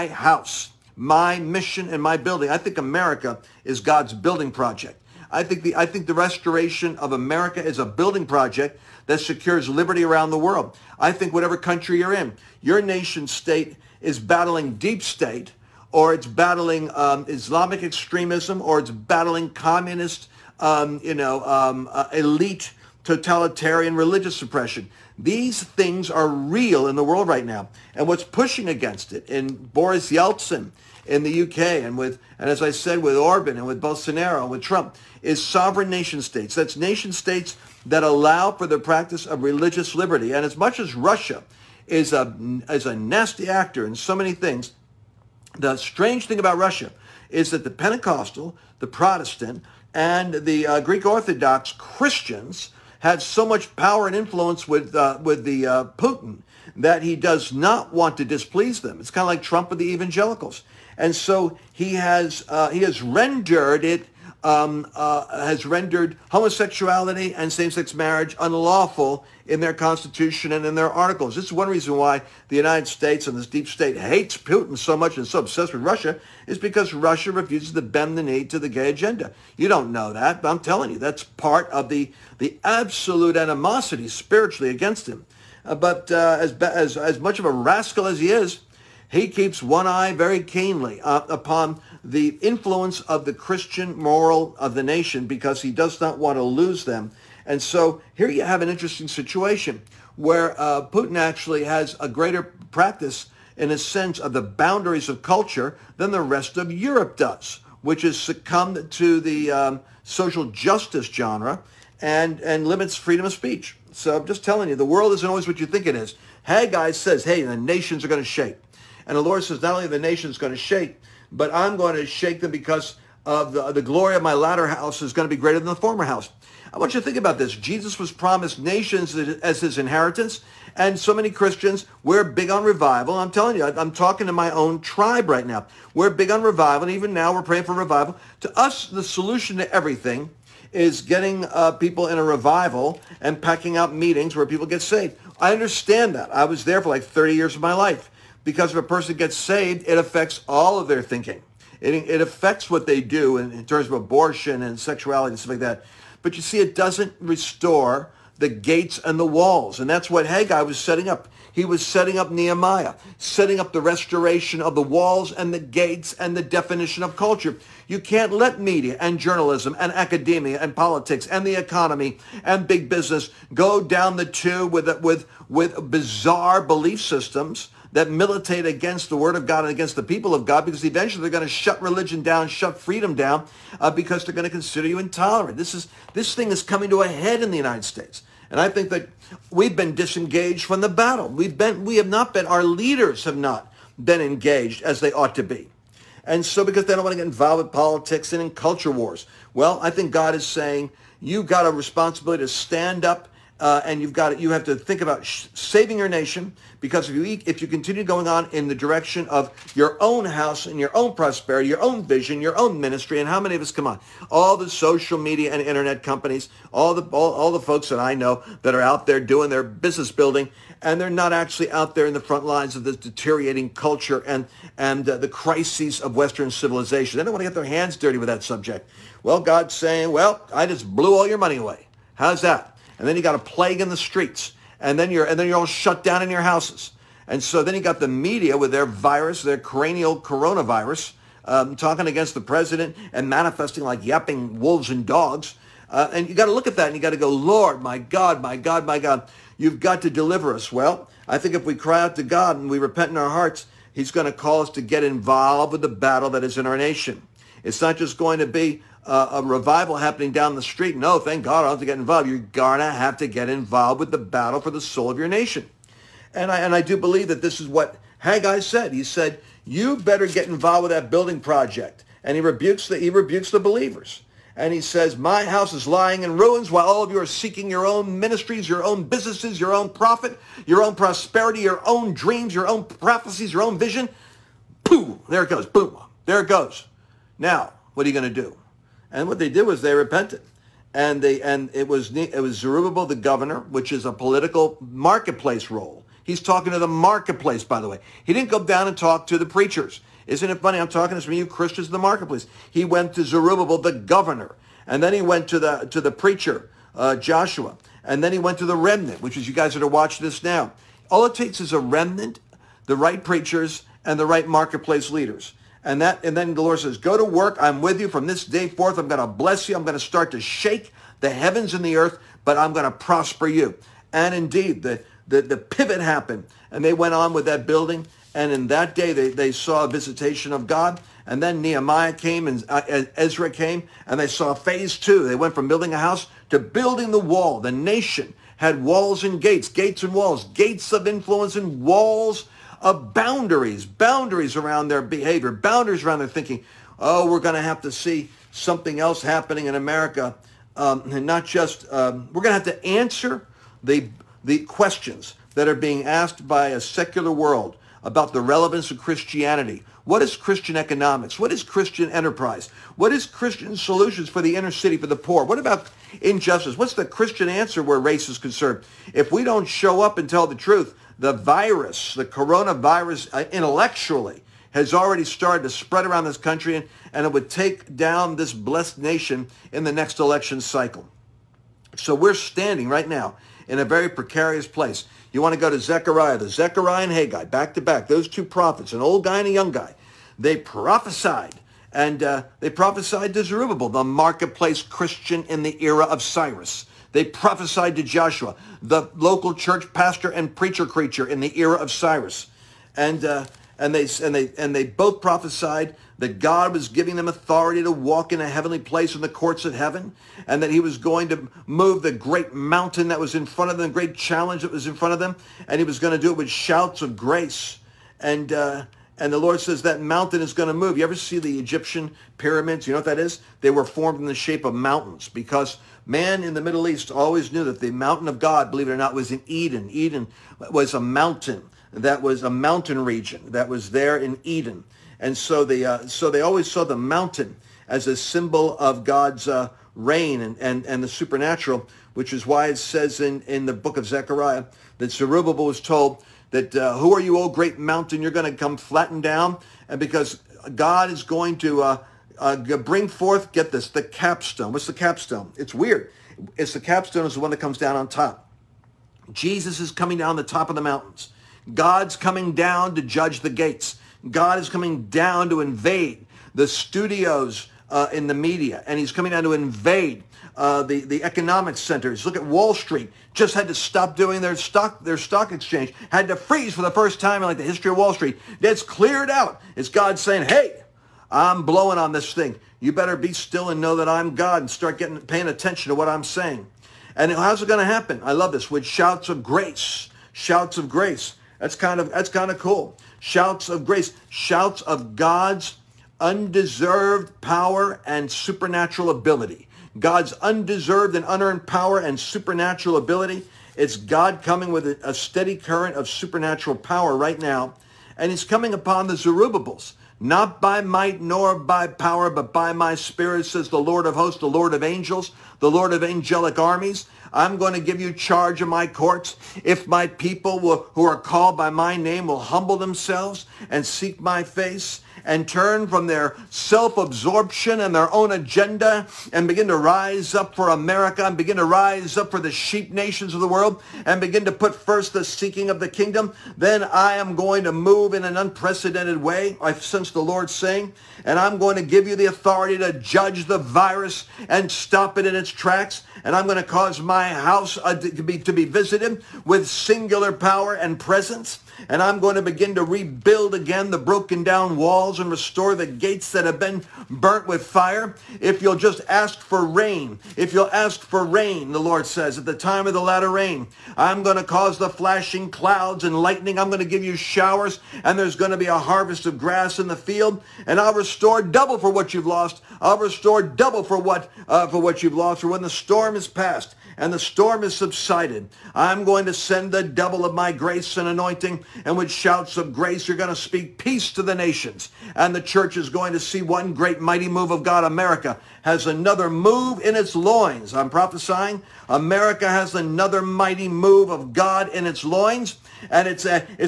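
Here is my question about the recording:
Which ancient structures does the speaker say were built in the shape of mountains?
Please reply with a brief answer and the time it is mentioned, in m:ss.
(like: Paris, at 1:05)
Egyptian pyramids, at 7:01.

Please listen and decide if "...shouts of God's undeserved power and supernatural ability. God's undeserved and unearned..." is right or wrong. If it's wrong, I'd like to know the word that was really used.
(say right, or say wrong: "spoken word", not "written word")
right.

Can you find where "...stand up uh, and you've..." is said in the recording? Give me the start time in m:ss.
3:22.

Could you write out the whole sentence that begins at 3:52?
And then you got a plague in the streets and then you're and then you're all shut down in your houses.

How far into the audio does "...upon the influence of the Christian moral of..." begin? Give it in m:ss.
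1:31.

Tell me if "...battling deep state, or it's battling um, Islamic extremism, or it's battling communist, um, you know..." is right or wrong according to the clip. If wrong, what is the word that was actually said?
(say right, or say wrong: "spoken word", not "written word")
right.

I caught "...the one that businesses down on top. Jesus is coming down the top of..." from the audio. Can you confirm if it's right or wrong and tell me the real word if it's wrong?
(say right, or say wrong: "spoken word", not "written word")
wrong: "comes", not "businesses".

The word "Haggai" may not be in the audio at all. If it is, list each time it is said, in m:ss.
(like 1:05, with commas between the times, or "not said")
1:56, 2:40, 4:28, 6:27.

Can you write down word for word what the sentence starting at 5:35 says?
They went from building a house to building the wall.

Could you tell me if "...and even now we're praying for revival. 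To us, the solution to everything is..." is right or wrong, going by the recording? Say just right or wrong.
right.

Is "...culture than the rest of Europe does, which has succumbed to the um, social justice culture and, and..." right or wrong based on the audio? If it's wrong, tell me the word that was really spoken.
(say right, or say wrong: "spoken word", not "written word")
wrong: "genre", not "culture".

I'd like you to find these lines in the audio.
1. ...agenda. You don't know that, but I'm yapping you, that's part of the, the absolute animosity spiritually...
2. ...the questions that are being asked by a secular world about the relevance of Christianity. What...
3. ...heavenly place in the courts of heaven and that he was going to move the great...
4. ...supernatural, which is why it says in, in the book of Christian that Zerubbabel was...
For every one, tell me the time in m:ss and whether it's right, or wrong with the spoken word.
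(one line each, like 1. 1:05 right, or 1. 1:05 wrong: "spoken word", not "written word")
1. 1:18 wrong: "telling", not "yapping"
2. 5:54 right
3. 6:48 right
4. 7:21 wrong: "Zechariah", not "Christian".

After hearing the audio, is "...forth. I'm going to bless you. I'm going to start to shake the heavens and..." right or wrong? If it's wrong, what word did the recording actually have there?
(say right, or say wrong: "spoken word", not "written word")
right.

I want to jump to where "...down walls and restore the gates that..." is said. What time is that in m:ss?
9:14.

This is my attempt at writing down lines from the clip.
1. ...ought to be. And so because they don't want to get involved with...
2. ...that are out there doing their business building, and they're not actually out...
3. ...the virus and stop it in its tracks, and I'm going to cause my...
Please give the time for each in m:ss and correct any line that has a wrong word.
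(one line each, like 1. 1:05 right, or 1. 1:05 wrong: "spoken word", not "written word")
1. 3:15 right
2. 3:38 right
3. 9:03 right.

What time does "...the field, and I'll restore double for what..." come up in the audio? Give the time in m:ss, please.
9:29.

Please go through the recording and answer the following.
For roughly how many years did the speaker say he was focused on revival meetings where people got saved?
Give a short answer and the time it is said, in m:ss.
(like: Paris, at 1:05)
30, at 2:27.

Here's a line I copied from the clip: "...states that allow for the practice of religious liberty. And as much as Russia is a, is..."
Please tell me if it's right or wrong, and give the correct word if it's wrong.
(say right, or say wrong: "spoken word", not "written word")
right.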